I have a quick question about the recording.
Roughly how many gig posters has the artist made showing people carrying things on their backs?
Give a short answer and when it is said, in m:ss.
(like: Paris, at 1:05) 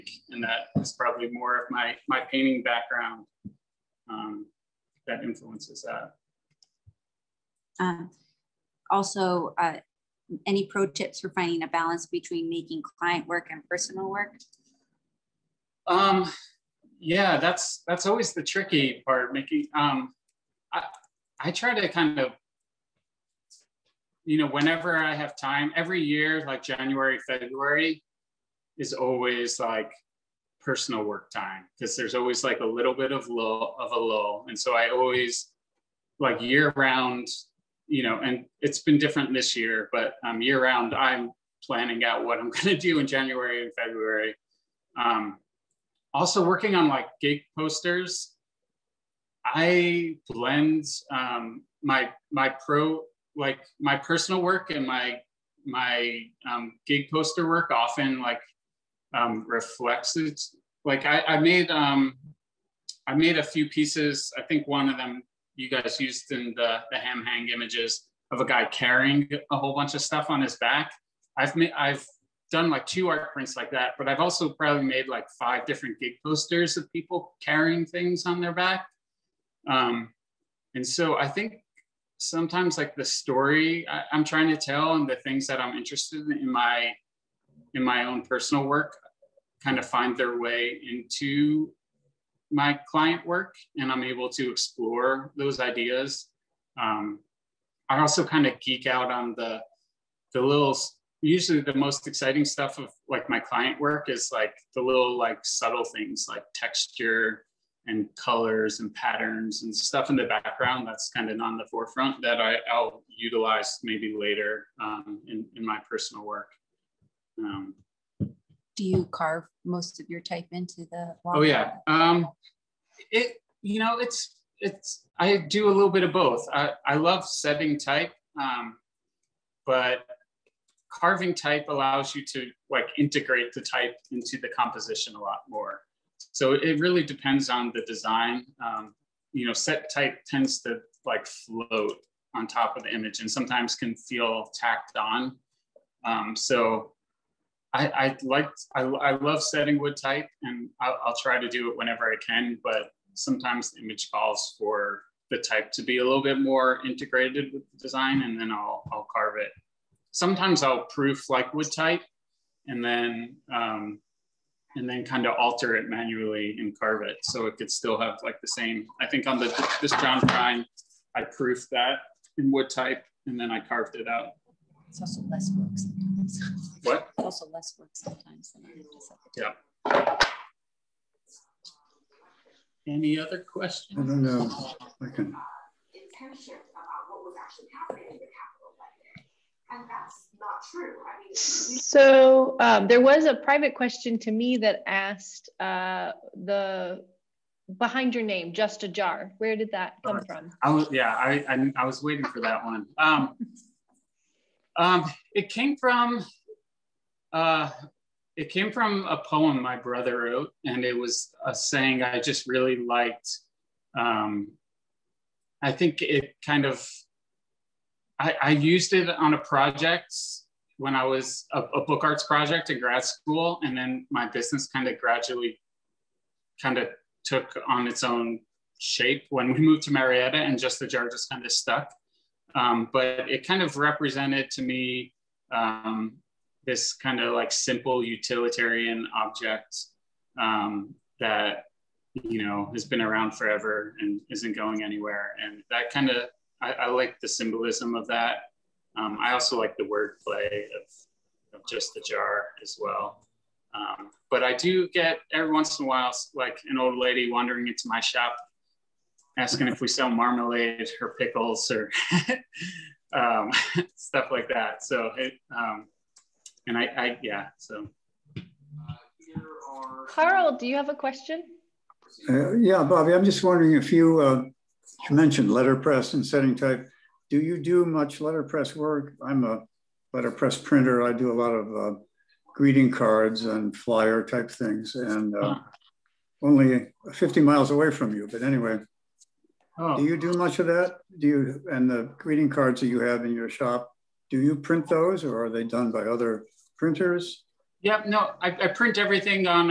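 5, at 1:15.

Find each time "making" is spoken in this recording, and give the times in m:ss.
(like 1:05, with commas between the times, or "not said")
0:12, 0:19.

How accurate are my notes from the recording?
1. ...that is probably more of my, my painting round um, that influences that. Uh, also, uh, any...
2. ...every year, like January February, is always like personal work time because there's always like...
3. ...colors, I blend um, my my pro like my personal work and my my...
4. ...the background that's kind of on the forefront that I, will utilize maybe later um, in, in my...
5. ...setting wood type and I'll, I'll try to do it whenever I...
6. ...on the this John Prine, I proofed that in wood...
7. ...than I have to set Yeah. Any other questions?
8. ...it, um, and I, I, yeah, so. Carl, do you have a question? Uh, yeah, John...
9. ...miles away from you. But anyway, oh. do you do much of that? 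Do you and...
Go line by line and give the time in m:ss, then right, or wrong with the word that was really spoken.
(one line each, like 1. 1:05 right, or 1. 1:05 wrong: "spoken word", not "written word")
1. 0:00 wrong: "background", not "round"
2. 0:25 right
3. 0:47 wrong: "posters", not "colors"
4. 1:50 right
5. 2:29 right
6. 2:49 right
7. 2:58 right
8. 4:25 wrong: "Bobby", not "John"
9. 4:47 right.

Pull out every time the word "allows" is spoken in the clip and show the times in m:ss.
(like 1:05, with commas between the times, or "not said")
2:11.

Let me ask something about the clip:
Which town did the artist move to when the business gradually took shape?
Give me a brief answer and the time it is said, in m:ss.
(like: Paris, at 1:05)
Marietta, at 3:49.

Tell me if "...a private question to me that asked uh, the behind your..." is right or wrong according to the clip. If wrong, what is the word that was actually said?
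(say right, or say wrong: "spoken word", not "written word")
right.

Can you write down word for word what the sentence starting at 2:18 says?
Um, you know, set type tends to like float on top of the image and sometimes can feel tacked on.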